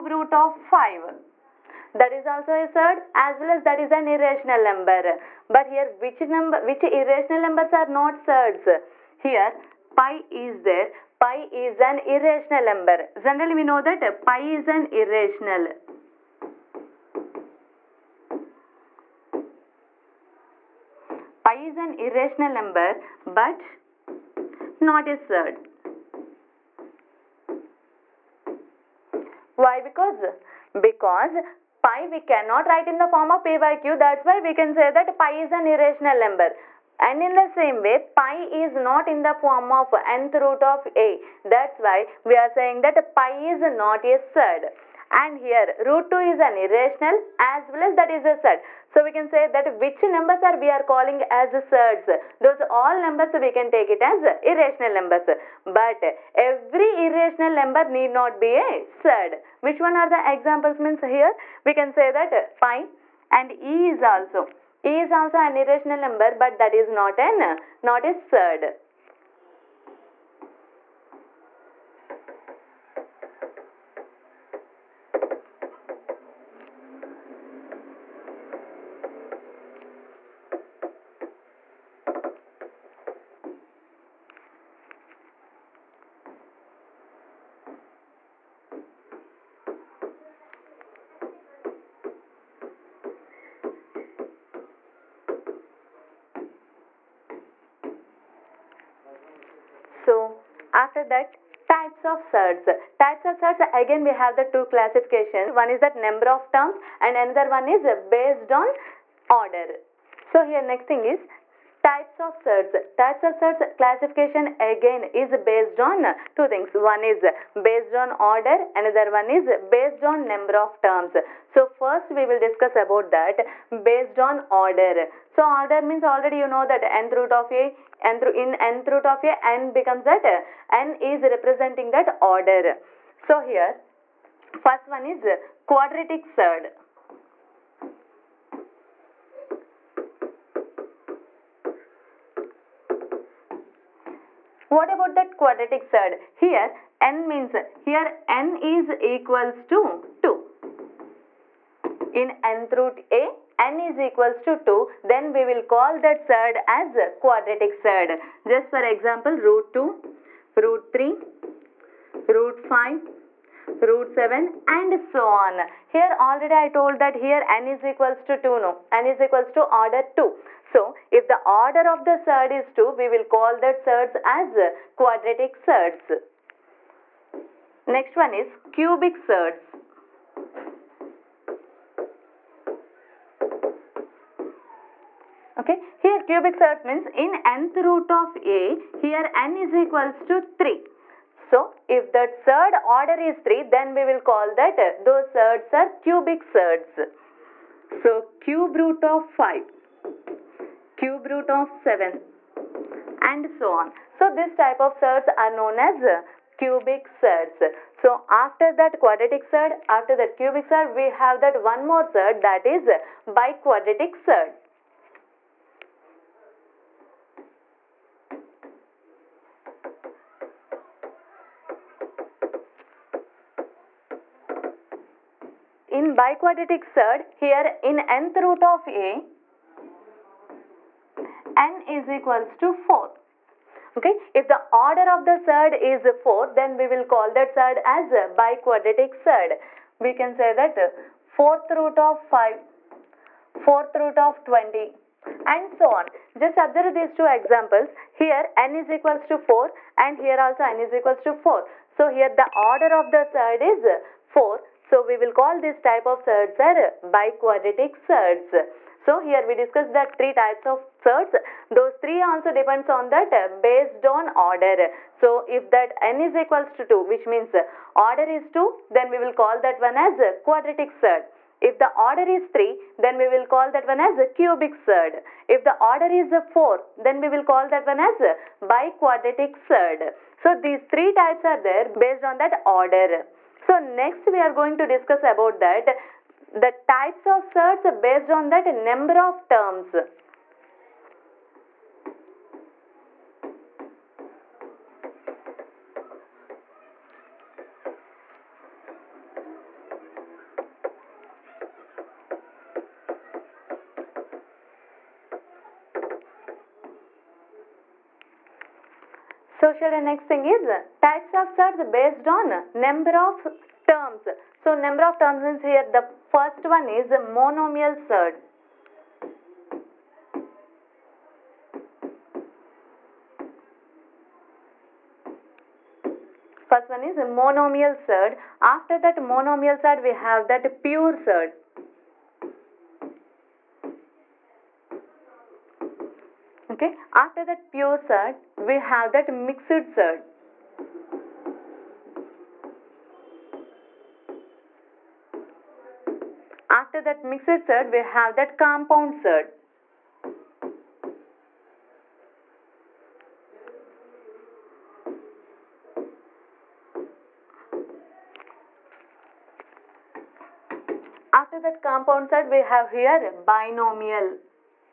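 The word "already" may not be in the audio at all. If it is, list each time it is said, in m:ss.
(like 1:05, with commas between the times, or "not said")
2:06, 2:46.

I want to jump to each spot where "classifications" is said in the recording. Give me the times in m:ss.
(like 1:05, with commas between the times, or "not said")
1:44, 1:53.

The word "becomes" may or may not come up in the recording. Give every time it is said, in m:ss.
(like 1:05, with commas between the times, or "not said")
2:09.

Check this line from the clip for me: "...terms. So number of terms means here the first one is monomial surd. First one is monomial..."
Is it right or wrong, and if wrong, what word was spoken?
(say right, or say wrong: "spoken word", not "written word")
right.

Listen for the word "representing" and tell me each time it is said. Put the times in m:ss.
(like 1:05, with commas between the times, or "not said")
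2:11.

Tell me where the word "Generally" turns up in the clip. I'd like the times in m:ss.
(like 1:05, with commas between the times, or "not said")
0:13.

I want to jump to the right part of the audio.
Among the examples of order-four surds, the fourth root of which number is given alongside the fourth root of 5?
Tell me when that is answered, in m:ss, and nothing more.
4:03.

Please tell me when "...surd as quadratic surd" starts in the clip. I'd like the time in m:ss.
2:36.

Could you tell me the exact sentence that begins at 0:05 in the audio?
But here which number, which irrational numbers are not surds?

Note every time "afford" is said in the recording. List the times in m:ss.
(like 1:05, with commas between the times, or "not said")
not said.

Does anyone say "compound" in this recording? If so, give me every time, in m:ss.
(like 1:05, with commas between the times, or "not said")
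5:48, 6:01.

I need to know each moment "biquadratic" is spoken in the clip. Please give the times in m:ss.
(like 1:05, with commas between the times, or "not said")
3:33, 3:46, 3:58, 4:17, 4:38.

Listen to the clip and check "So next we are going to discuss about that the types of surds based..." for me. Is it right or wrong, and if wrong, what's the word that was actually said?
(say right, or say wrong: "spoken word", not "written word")
right.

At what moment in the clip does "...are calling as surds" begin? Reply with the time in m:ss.
0:50.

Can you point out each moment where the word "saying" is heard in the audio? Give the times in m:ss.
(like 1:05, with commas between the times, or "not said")
0:42.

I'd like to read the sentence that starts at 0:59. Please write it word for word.
Which one are the examples means here we can say that pi and e is also.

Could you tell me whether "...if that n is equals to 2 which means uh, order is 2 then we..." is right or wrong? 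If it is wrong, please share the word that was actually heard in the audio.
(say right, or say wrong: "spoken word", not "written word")
right.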